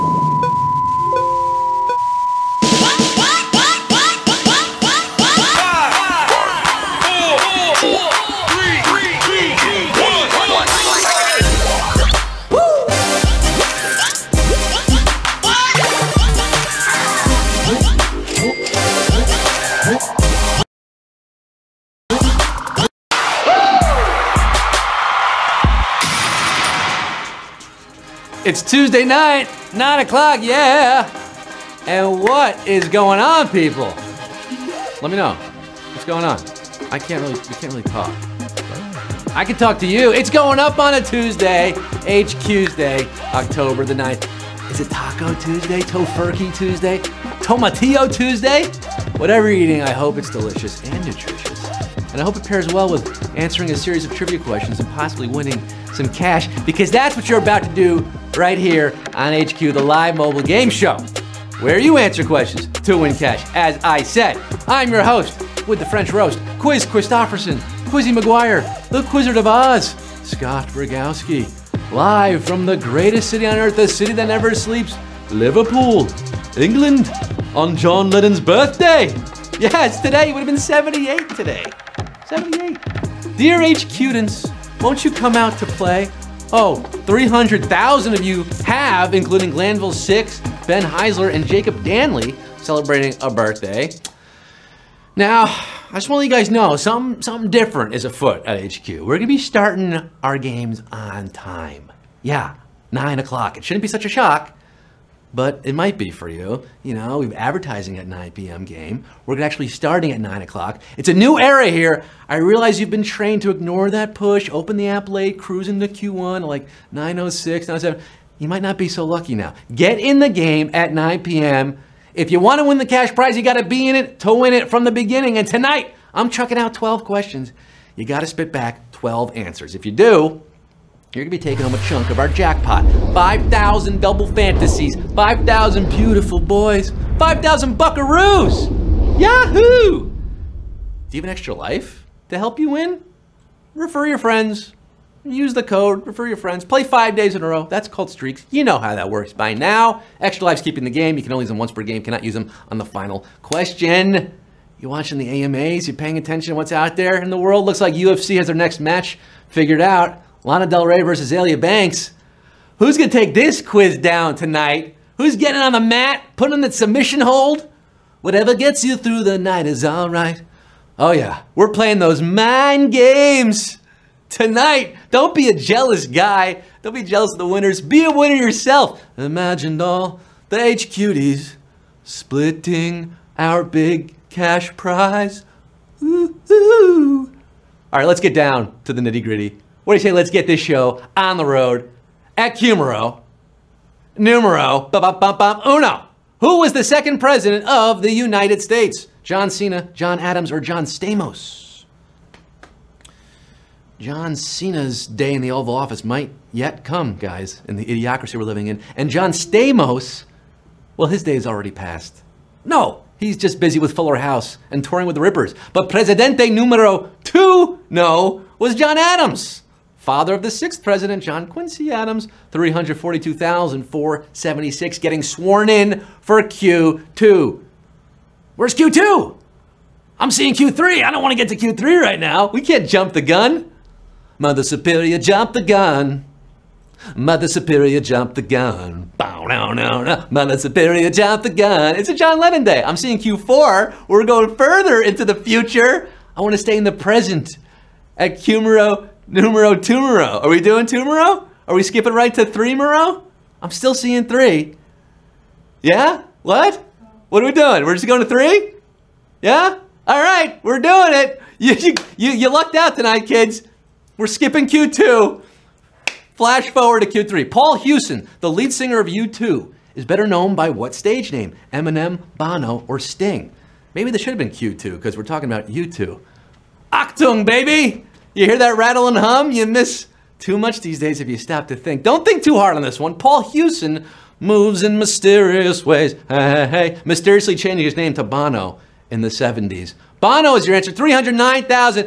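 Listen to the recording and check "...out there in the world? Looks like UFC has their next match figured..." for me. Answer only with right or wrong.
right.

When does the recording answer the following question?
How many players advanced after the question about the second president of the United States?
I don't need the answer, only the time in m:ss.
3:42.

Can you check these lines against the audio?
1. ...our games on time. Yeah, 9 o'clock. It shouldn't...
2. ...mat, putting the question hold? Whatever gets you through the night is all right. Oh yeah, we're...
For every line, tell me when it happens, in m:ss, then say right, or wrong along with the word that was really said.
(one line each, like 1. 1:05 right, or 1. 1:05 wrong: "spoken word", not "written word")
1. 1:40 right
2. 2:45 wrong: "submission", not "question".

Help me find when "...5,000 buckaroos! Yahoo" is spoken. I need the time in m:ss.
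2:17.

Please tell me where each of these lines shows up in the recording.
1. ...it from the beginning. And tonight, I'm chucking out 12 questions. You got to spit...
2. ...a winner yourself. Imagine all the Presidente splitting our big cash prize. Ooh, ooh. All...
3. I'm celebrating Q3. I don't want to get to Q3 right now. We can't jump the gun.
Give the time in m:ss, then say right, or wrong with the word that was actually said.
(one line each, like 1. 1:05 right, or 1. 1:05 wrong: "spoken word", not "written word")
1. 2:04 right
2. 2:58 wrong: "HQDs", not "Presidente"
3. 3:50 wrong: "seeing", not "celebrating".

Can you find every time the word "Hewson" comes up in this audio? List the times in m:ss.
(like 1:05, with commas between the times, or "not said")
4:27, 4:43.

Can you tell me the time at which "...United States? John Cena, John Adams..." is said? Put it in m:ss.
3:18.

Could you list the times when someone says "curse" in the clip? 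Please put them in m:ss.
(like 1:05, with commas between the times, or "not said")
not said.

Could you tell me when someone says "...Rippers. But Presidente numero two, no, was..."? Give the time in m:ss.
3:35.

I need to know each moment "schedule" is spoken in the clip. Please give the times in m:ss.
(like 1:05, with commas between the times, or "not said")
not said.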